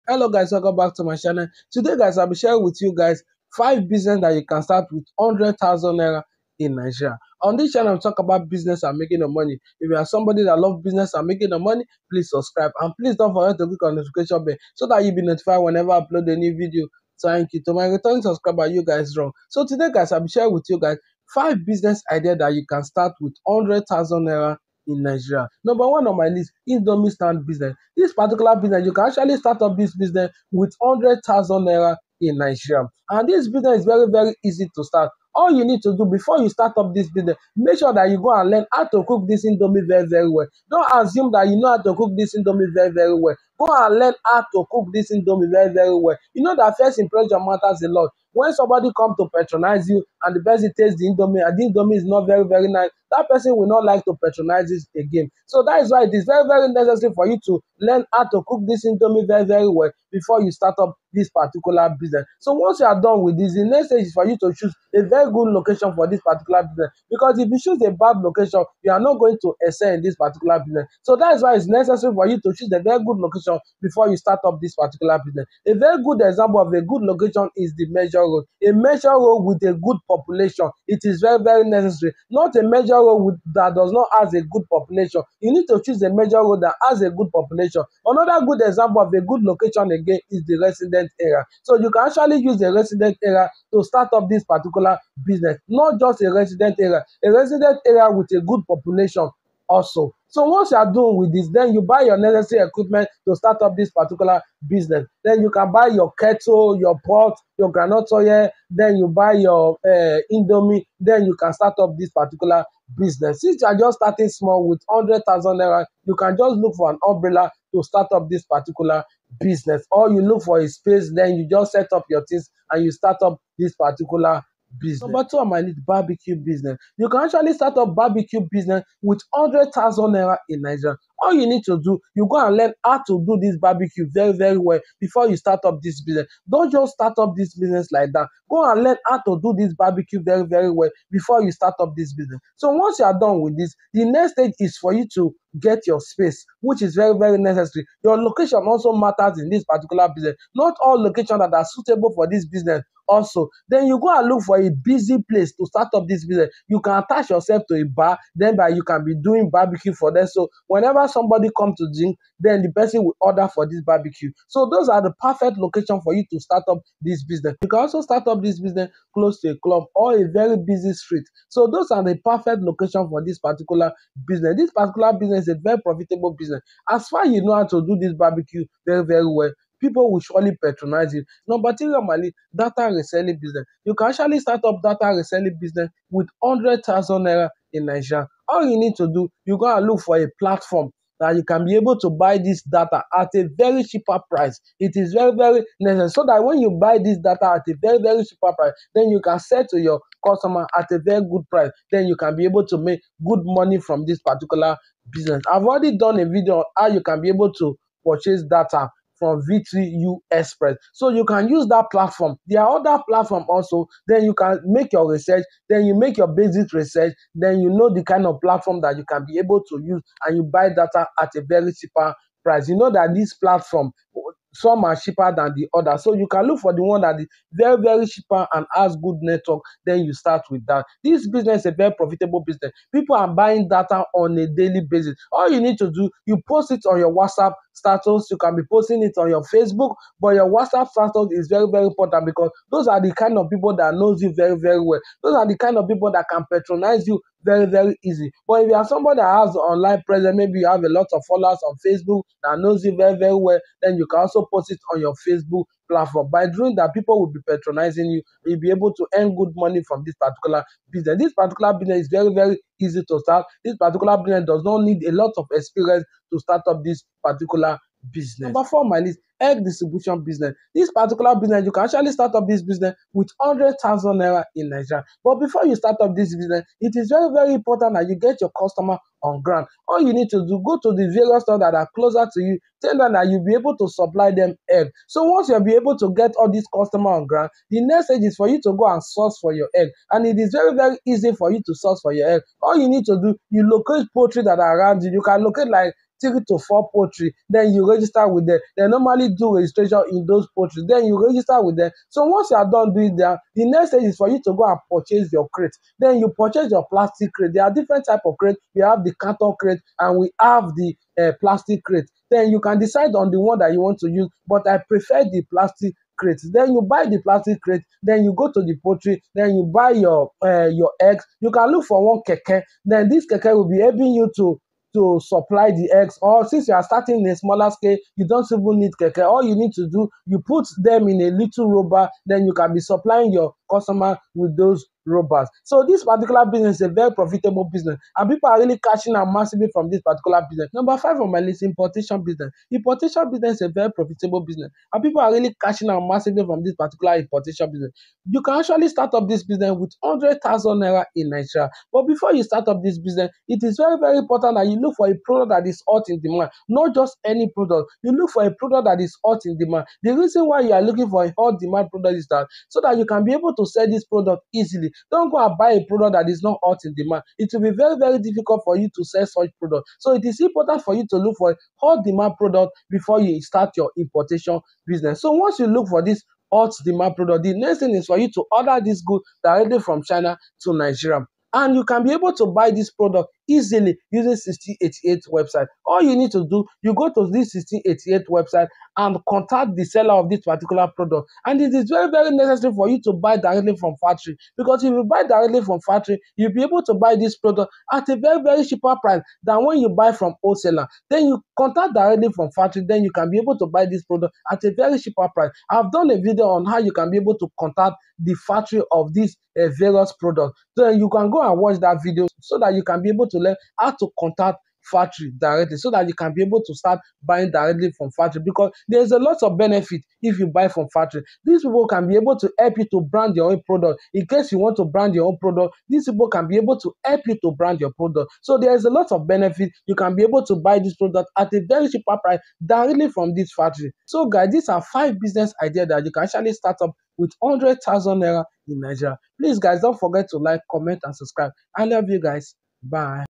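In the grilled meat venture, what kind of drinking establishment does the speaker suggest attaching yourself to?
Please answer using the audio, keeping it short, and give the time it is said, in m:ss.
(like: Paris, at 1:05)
A bar, at 2:37.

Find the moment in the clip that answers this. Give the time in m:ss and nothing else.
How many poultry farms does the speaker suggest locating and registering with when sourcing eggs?
4:56.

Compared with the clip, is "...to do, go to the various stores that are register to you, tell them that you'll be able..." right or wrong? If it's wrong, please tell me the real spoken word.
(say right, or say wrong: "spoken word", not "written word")
wrong: "closer", not "register".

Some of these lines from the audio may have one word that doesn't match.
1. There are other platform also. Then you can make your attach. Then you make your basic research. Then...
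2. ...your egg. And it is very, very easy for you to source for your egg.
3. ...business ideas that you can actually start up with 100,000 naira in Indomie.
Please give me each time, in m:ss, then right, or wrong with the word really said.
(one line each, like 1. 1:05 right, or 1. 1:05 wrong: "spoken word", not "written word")
1. 3:32 wrong: "research", not "attach"
2. 4:49 right
3. 7:15 wrong: "Nigeria", not "Indomie".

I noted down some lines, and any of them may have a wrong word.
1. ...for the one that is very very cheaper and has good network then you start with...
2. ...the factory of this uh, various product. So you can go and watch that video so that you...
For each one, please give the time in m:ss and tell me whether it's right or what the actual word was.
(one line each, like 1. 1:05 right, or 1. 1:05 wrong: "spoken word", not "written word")
1. 3:46 right
2. 6:48 right.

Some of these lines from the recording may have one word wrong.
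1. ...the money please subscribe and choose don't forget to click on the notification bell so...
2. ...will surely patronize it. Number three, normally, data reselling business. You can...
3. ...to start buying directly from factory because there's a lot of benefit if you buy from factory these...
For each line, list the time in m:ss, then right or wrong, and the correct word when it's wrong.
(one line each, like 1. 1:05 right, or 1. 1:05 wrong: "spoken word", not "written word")
1. 0:11 wrong: "please", not "choose"
2. 3:00 right
3. 6:56 right.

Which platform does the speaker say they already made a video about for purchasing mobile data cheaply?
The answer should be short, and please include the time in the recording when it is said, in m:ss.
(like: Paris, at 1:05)
V3 U Express, at 3:29.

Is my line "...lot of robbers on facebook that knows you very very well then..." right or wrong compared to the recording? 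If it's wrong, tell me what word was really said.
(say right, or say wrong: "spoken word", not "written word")
wrong: "followers", not "robbers".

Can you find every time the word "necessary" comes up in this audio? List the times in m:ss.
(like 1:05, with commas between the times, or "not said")
0:56, 1:11, 1:21, 1:42, 2:27, 3:15, 6:32.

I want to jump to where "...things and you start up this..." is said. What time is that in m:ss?
2:02.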